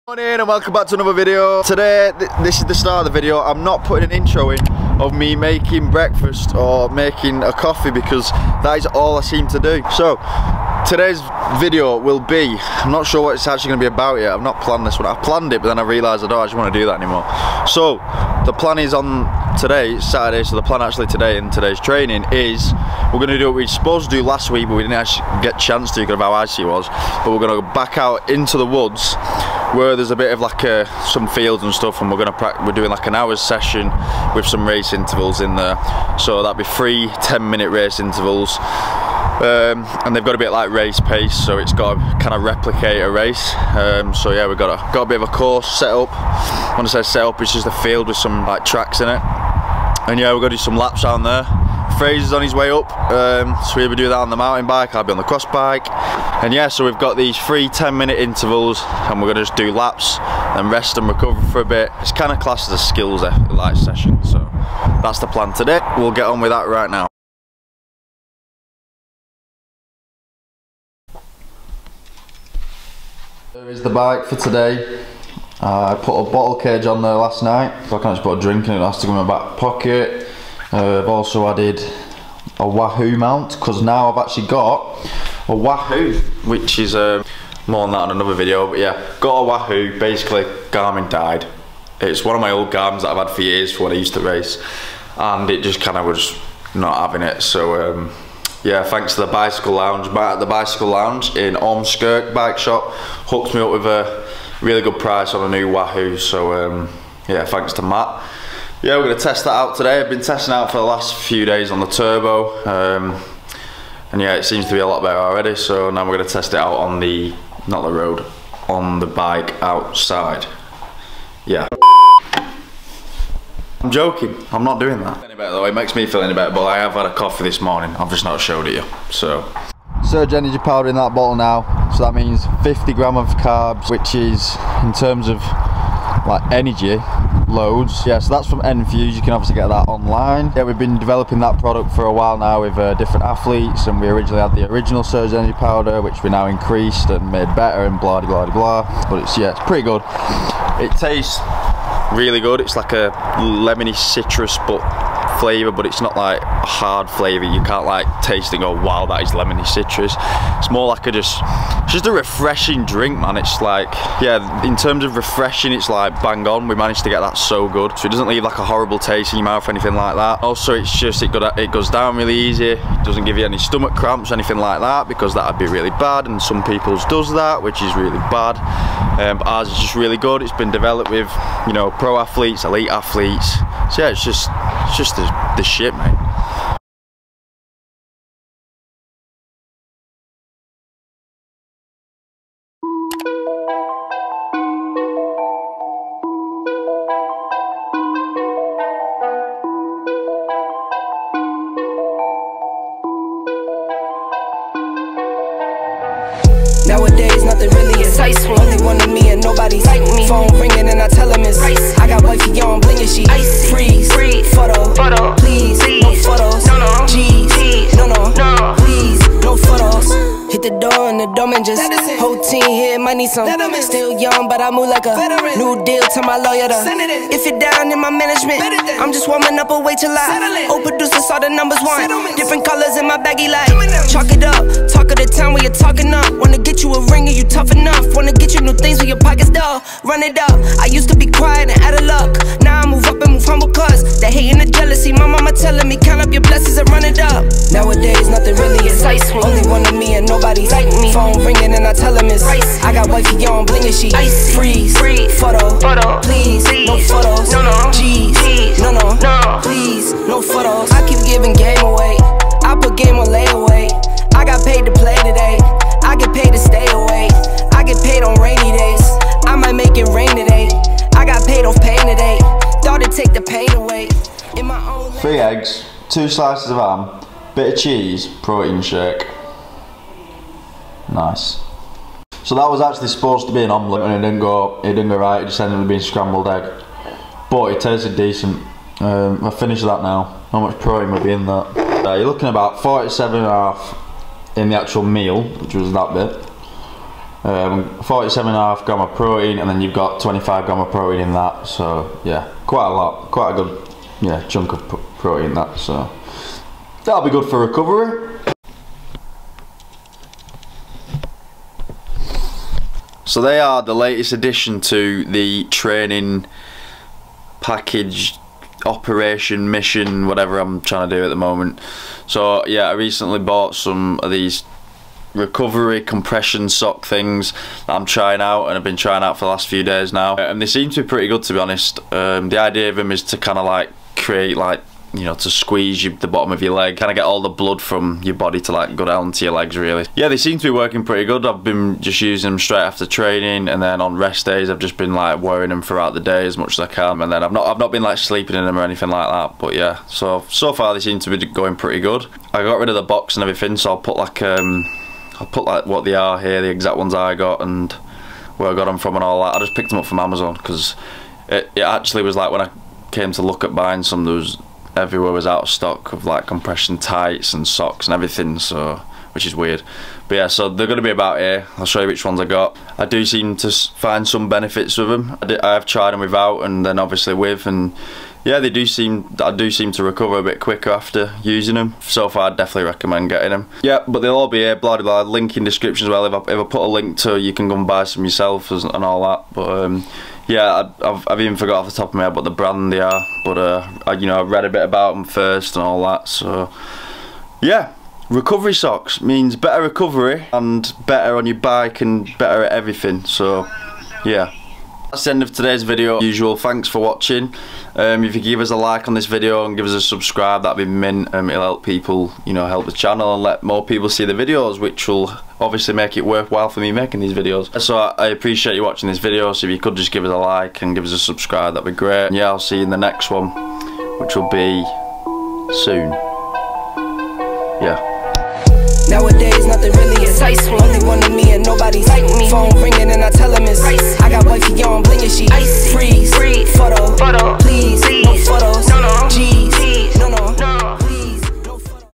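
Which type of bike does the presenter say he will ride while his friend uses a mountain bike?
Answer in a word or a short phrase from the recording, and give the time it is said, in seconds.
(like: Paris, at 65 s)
cross bike, at 55 s.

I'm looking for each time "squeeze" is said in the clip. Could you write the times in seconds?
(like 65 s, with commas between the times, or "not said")
335 s.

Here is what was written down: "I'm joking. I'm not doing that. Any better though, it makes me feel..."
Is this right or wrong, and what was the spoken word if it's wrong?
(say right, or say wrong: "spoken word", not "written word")
right.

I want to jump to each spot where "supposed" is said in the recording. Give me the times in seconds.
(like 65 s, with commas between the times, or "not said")
23 s, 283 s.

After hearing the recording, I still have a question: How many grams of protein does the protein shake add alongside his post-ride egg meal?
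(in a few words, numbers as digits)
25.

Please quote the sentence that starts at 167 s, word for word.
So it doesn't leave like a horrible taste in your mouth or anything like that.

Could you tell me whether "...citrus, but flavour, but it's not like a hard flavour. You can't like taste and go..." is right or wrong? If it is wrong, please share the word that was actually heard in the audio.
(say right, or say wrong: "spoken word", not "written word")
right.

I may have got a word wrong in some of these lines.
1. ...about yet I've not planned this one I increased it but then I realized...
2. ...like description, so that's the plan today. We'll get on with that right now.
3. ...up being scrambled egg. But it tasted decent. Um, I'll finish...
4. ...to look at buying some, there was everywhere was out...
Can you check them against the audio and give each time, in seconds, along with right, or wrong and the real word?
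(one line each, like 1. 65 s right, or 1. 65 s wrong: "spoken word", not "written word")
1. 13 s wrong: "planned", not "increased"
2. 63 s wrong: "session", not "description"
3. 285 s right
4. 363 s right.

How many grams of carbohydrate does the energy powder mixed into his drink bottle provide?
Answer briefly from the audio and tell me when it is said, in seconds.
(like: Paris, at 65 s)
50, at 132 s.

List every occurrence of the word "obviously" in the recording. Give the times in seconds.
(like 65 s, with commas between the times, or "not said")
139 s, 376 s, 415 s.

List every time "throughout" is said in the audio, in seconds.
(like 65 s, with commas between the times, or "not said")
345 s.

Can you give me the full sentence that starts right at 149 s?
But it's yeah, it's pretty good.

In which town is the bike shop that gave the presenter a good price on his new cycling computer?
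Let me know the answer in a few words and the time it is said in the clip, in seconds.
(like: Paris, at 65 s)
Ormskirk, at 101 s.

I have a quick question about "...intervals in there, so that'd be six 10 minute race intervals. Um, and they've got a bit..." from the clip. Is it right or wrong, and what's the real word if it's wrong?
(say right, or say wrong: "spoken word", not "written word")
wrong: "three", not "six".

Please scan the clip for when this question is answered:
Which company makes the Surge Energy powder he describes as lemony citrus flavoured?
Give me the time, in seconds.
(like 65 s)
138 s.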